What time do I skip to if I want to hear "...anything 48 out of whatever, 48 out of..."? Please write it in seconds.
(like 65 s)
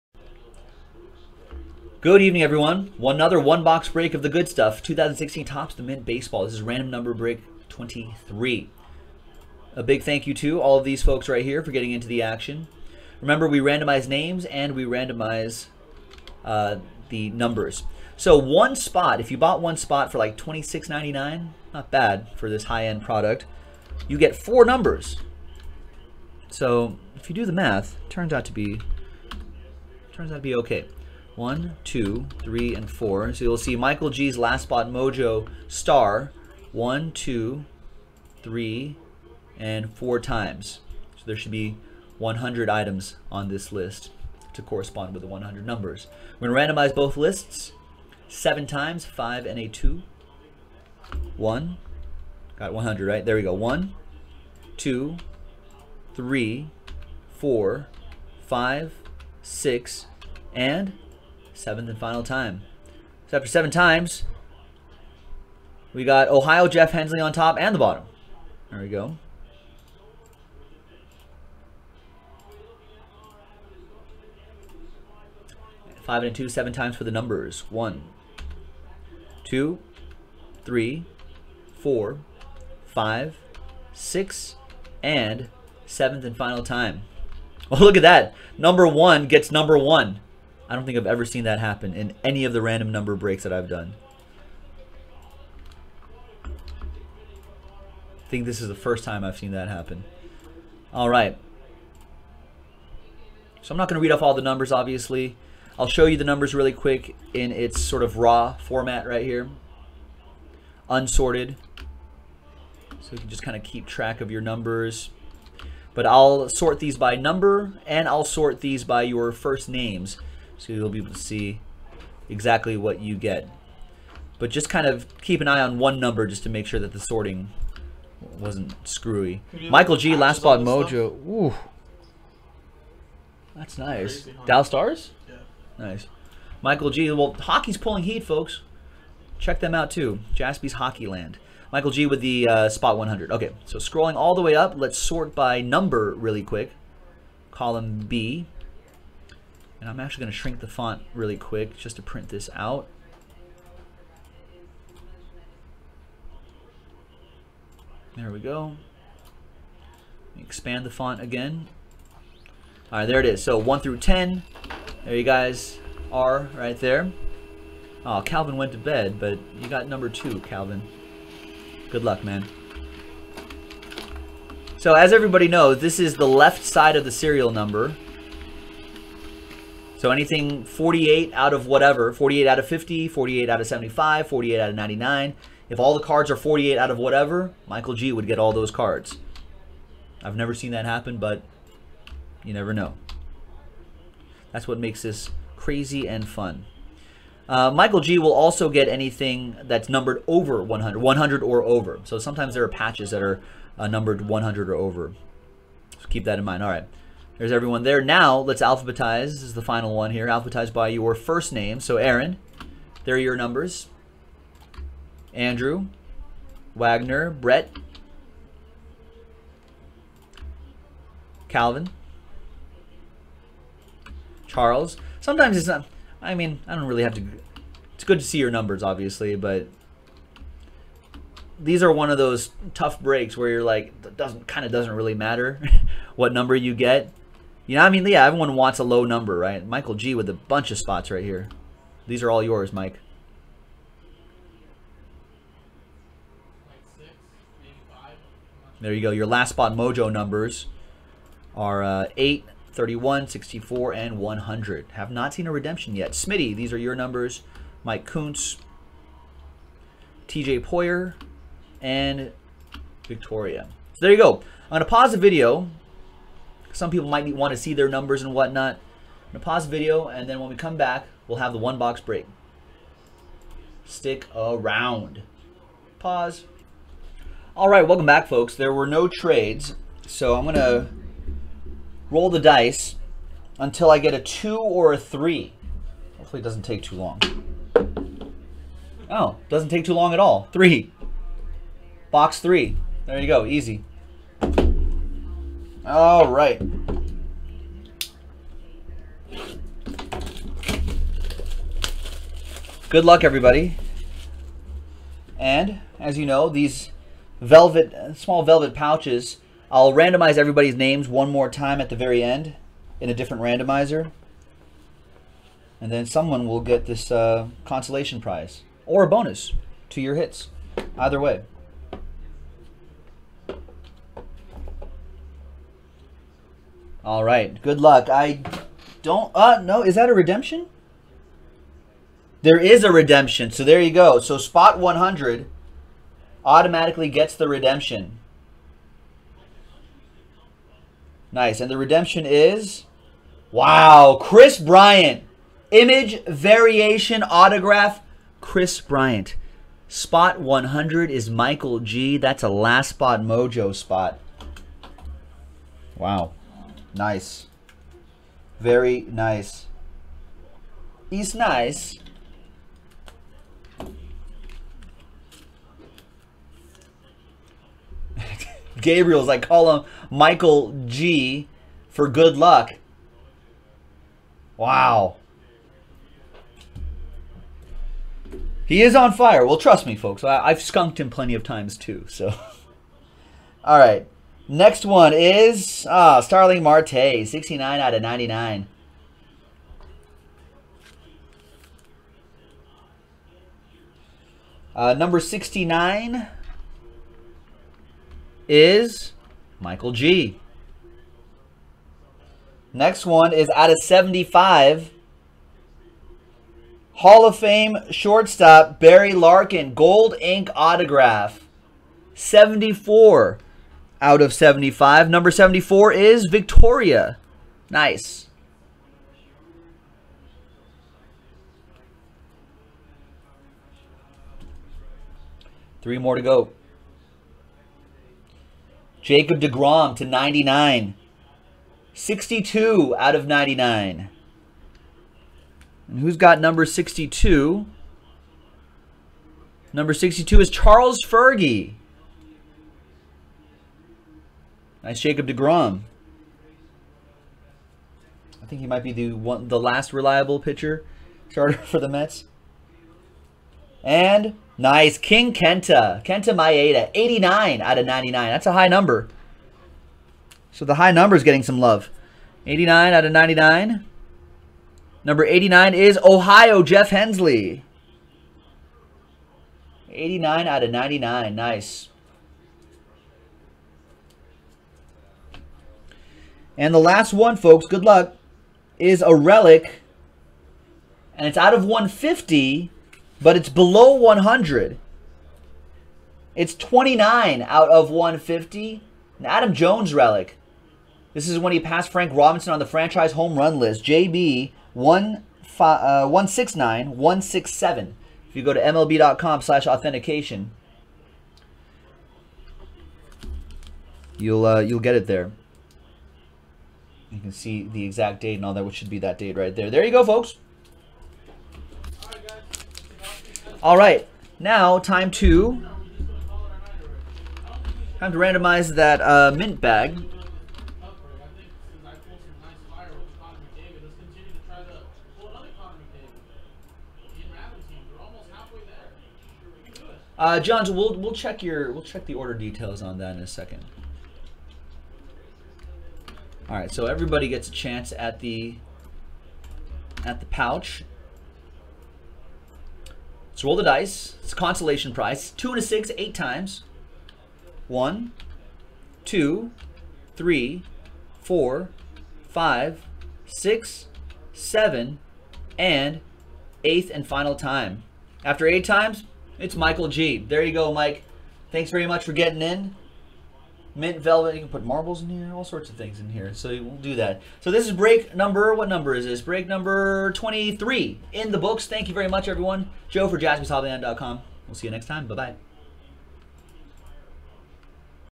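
180 s.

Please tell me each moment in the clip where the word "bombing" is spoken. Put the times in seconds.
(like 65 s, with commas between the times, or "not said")
not said.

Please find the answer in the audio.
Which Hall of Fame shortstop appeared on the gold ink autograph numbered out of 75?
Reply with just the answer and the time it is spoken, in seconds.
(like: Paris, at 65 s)
Barry Larkin, at 408 s.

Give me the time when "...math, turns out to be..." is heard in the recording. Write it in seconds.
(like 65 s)
27 s.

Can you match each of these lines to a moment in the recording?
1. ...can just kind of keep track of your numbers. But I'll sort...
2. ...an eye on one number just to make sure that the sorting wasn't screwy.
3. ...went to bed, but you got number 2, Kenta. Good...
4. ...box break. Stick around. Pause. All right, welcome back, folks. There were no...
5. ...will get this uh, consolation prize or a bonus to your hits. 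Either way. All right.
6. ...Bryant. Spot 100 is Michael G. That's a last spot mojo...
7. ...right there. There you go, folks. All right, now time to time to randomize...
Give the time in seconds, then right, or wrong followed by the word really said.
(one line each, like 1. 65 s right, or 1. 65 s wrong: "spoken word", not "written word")
1. 113 s right
2. 125 s right
3. 168 s wrong: "Calvin", not "Kenta"
4. 271 s right
5. 316 s right
6. 348 s right
7. 509 s right.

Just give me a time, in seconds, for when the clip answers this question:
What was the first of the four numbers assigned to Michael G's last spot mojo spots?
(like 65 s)
252 s.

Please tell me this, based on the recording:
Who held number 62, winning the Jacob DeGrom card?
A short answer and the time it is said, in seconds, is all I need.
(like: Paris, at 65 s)
Charles Fergie, at 440 s.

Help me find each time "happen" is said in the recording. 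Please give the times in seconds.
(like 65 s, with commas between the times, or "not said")
91 s, 99 s, 190 s.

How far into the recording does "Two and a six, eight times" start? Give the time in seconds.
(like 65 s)
545 s.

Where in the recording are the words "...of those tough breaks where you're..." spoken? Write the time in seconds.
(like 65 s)
232 s.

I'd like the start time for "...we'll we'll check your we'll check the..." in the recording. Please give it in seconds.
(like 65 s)
530 s.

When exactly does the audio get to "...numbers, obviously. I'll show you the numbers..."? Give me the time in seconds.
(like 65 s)
104 s.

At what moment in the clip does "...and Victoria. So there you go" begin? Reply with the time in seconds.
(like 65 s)
261 s.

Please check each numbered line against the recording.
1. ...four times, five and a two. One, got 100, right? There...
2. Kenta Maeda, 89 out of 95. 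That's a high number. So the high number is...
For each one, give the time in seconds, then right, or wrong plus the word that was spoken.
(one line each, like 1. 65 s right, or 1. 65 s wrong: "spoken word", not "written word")
1. 48 s wrong: "seven", not "four"
2. 456 s wrong: "99", not "95".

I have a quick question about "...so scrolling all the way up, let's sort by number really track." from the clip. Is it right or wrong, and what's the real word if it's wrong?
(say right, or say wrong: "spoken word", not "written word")
wrong: "quick", not "track".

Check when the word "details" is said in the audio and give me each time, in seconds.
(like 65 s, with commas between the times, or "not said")
532 s.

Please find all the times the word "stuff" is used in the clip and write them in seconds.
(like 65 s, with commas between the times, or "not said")
4 s, 131 s.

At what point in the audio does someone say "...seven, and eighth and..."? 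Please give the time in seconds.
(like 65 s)
554 s.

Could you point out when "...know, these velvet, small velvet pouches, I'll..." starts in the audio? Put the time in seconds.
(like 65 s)
306 s.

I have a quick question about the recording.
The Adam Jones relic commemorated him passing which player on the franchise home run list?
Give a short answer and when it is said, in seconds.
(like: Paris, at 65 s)
Frank Robinson, at 491 s.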